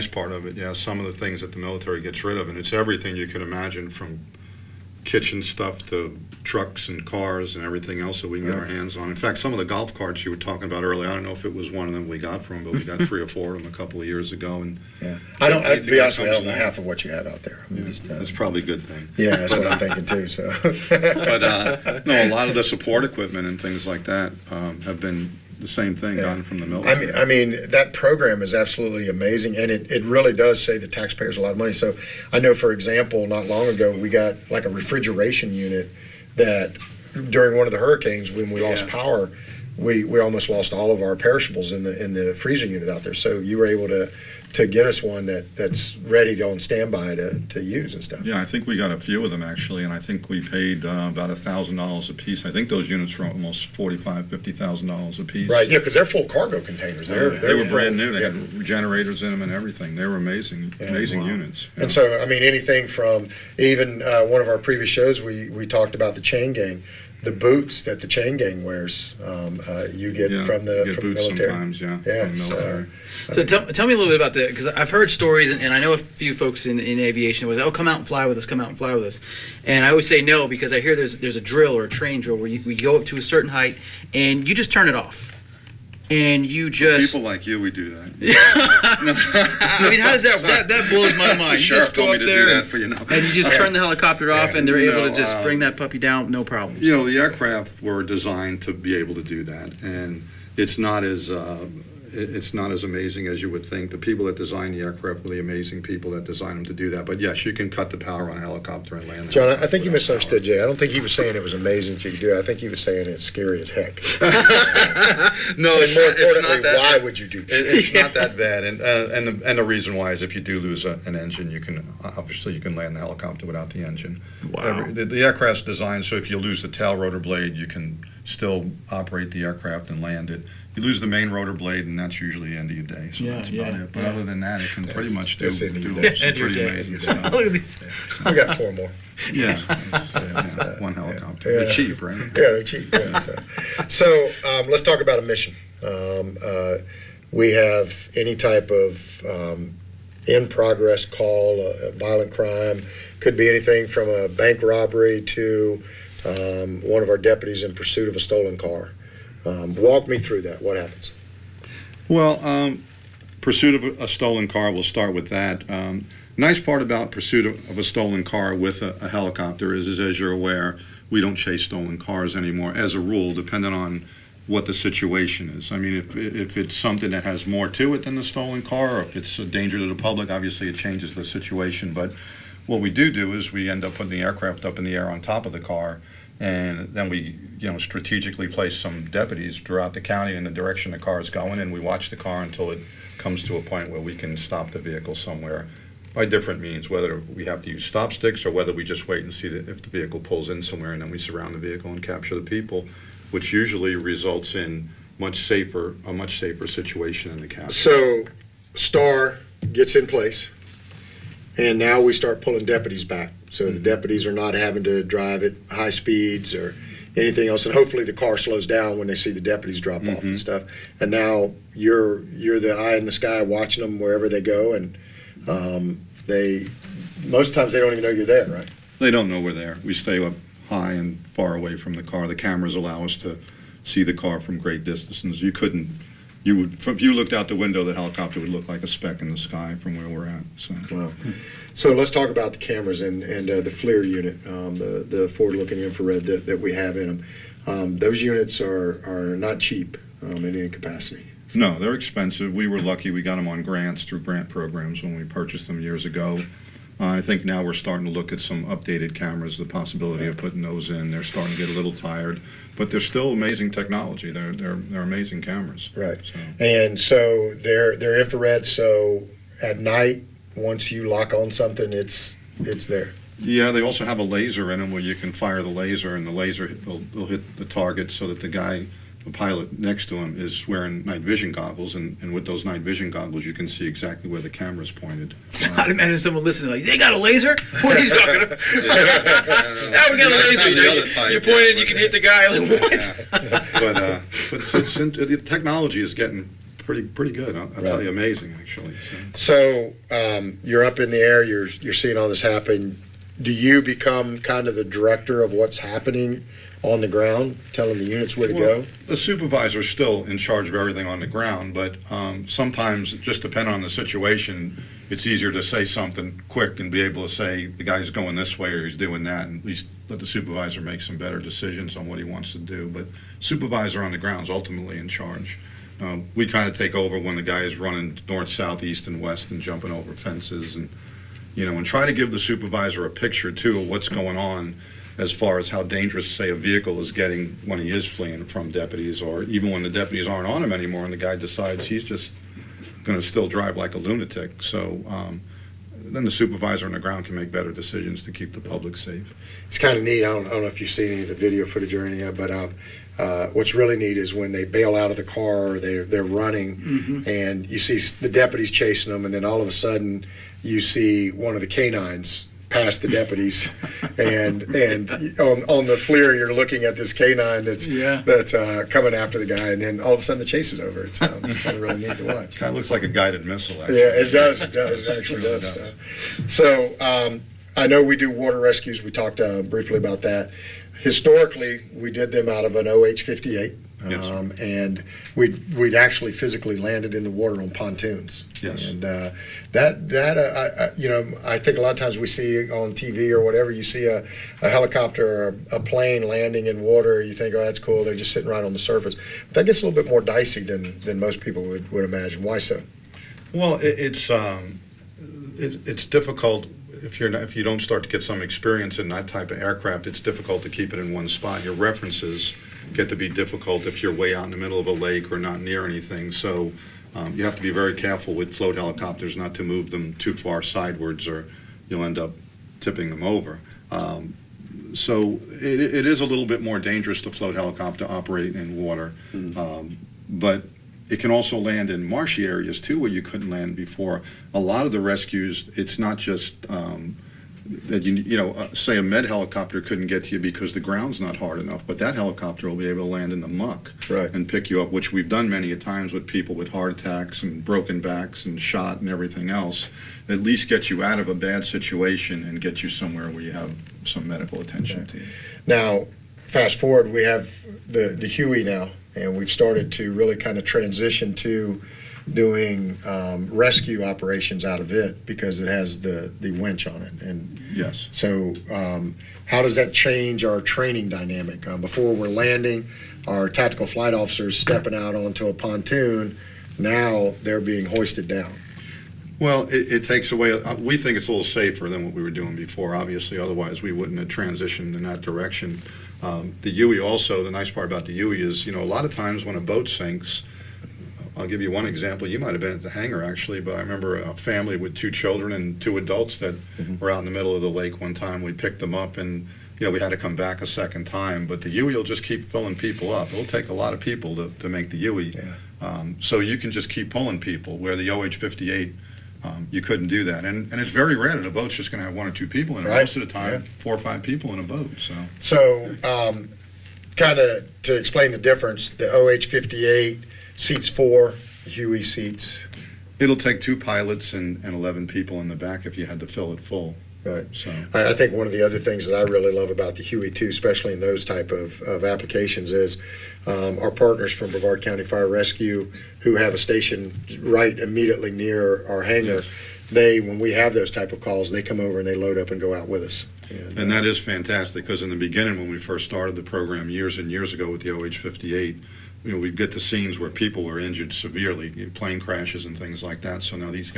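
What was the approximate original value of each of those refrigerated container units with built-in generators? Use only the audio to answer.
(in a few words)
$45,000 to $50,000.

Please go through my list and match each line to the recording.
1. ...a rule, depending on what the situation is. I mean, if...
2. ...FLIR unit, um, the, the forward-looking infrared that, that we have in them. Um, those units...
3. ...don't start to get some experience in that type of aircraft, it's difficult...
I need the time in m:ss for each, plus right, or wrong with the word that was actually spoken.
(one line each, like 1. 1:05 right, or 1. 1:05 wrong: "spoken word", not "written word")
1. 2:52 right
2. 4:03 right
3. 6:47 right.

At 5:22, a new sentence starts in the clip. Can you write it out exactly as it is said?
But supervisor on the ground is ultimately in charge.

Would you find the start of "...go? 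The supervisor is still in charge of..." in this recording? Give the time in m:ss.
5:08.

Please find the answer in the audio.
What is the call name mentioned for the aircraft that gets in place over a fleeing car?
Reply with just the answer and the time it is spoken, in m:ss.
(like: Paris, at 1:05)
Star, at 3:28.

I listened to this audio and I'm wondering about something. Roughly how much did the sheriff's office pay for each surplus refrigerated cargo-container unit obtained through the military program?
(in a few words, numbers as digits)
about $1,000.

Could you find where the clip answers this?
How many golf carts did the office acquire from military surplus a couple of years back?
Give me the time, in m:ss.
0:13.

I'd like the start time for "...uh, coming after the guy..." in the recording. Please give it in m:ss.
6:08.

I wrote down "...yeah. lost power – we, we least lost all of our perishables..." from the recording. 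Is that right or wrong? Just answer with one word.
wrong.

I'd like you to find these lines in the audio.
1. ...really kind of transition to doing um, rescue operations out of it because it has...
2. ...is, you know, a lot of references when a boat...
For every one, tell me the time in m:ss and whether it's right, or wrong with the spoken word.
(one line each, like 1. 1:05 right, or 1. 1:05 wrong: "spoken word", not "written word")
1. 7:40 right
2. 8:08 wrong: "times", not "references".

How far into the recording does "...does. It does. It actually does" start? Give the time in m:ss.
6:14.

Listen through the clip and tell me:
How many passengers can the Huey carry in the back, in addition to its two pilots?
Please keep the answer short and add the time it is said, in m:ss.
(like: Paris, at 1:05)
11, at 8:44.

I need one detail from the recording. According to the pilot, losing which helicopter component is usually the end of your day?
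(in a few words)
main rotor blade.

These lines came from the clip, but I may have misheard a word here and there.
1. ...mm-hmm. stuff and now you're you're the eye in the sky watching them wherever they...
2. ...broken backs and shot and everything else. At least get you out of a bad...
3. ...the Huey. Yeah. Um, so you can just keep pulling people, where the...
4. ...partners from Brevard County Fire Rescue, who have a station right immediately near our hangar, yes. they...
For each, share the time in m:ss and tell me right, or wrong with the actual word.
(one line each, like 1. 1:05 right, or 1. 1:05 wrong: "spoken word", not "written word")
1. 3:40 right
2. 7:27 right
3. 8:24 right
4. 8:53 right.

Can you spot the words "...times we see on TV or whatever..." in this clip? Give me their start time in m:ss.
6:31.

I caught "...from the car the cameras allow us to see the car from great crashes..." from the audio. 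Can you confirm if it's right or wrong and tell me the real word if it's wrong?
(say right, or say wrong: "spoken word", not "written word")
wrong: "distances", not "crashes".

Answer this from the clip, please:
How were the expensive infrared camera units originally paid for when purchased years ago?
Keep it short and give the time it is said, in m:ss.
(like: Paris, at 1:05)
grants, at 4:14.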